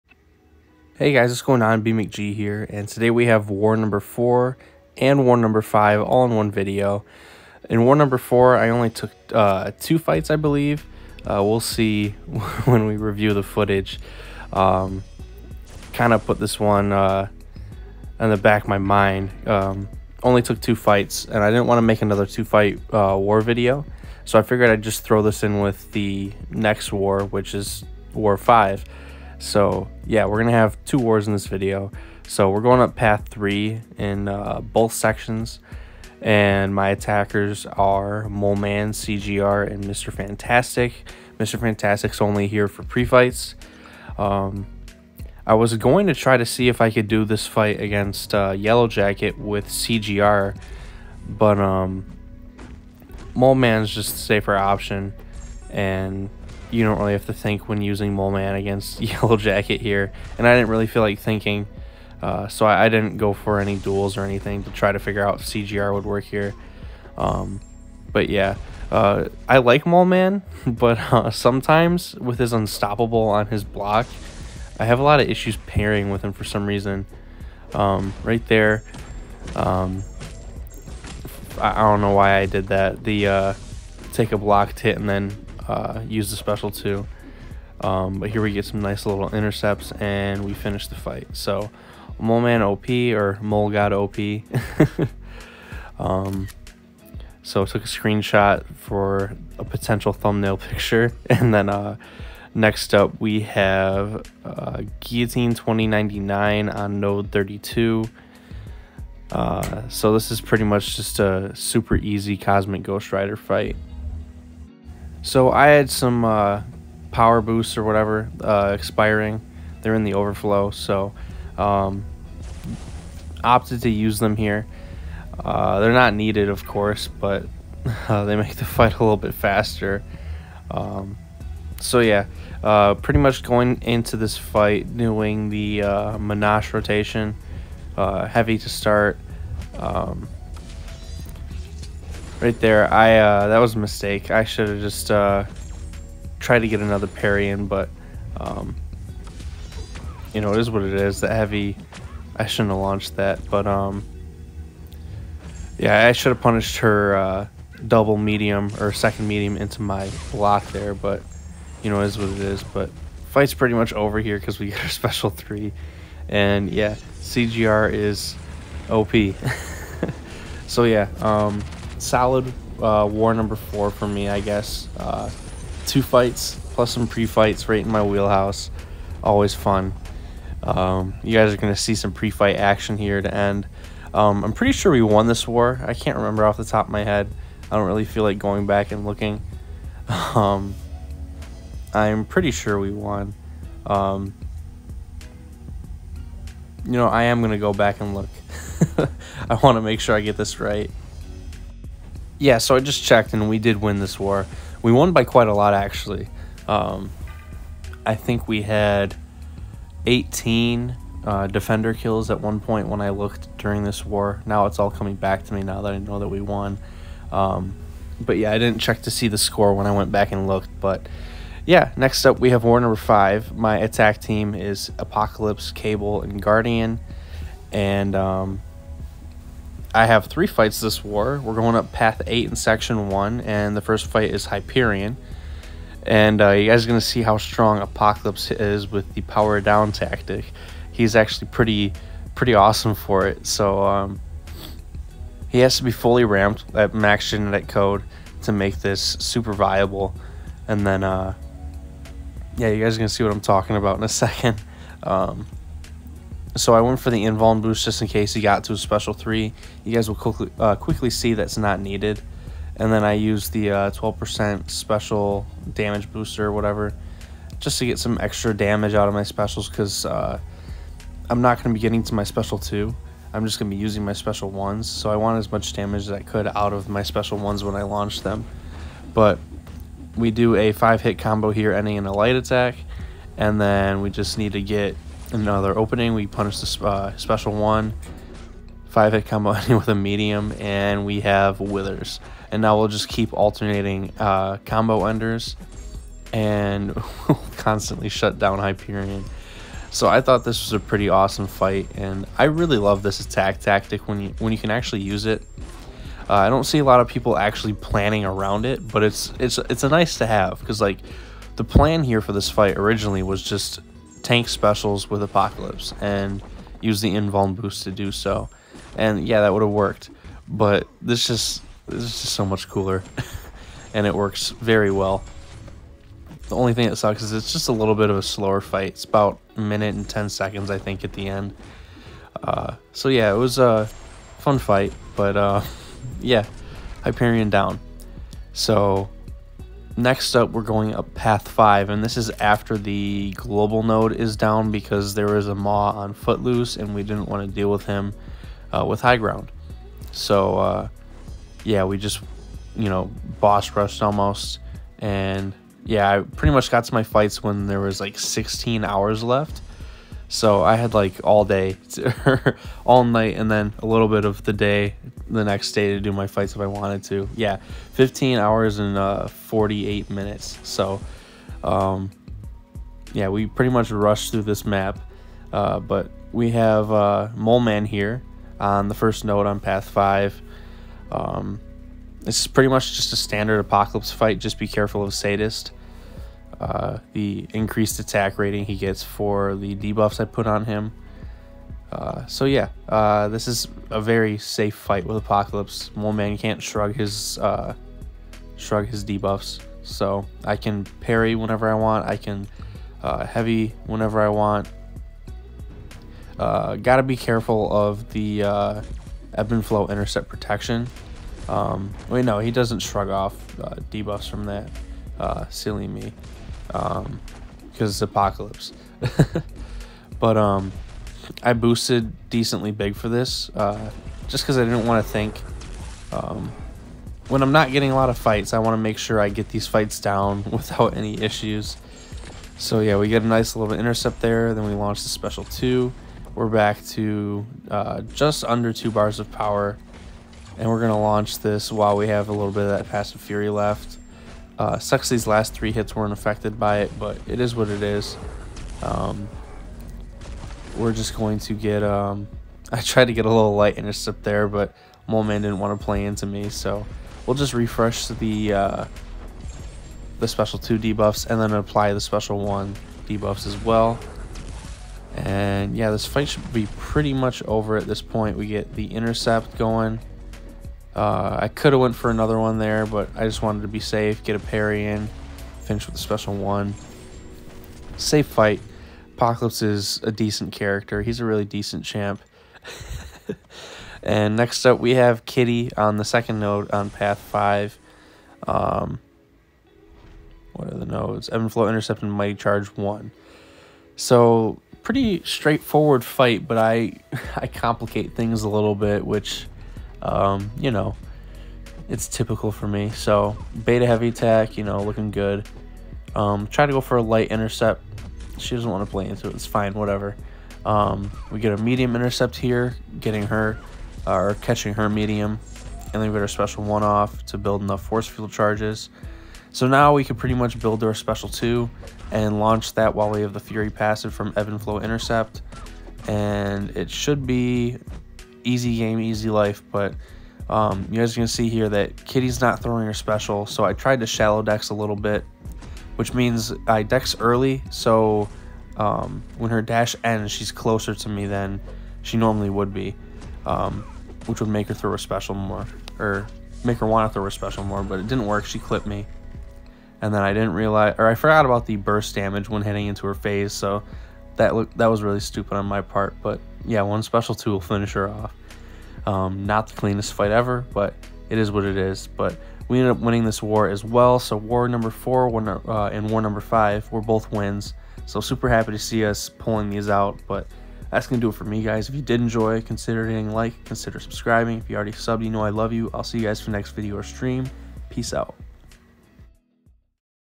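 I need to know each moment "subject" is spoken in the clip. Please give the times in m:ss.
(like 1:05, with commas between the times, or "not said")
not said.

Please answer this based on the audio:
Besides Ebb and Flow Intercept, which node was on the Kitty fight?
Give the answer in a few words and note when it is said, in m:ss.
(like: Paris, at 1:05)
Mighty Charge 1, at 8:12.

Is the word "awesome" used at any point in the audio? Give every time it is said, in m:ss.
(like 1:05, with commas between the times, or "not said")
4:02, 5:01.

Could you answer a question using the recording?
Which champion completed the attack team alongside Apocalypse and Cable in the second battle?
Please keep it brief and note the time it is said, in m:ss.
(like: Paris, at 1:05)
Guardian, at 3:46.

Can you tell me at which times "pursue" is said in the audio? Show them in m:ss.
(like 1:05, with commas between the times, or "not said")
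not said.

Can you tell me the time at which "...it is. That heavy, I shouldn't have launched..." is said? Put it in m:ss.
2:30.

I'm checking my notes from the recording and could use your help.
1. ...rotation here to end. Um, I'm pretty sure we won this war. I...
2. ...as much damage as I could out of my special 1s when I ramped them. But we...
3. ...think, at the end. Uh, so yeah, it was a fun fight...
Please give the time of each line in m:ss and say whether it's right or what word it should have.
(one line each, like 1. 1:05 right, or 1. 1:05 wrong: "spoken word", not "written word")
1. 3:02 wrong: "action", not "rotation"
2. 4:35 wrong: "launched", not "ramped"
3. 5:30 right.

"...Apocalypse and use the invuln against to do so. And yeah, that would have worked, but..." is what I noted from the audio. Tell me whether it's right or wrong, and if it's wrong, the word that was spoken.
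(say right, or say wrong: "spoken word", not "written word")
wrong: "boost", not "against".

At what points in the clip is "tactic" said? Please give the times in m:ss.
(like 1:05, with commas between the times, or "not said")
3:59, 5:03.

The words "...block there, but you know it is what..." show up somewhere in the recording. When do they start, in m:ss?
2:40.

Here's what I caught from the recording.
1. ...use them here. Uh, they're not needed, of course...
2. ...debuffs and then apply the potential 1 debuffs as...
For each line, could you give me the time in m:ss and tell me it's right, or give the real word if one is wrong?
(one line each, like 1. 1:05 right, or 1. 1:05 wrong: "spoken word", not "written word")
1. 2:03 right
2. 7:40 wrong: "special", not "potential".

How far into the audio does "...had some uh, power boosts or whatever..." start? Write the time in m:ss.
1:55.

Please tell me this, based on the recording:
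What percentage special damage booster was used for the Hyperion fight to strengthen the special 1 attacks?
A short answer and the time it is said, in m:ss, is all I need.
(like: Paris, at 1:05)
12%, at 4:23.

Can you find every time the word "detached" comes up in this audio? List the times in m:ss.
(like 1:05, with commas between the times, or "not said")
not said.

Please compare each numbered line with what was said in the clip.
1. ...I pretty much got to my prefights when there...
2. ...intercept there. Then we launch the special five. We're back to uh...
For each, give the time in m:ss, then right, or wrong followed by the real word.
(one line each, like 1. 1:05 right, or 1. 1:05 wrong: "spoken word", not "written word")
1. 5:56 wrong: "fights", not "prefights"
2. 7:13 wrong: "two", not "five".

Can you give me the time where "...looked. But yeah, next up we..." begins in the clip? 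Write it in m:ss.
3:40.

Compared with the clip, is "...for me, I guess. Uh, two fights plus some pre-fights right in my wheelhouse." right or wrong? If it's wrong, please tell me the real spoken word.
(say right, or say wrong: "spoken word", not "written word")
right.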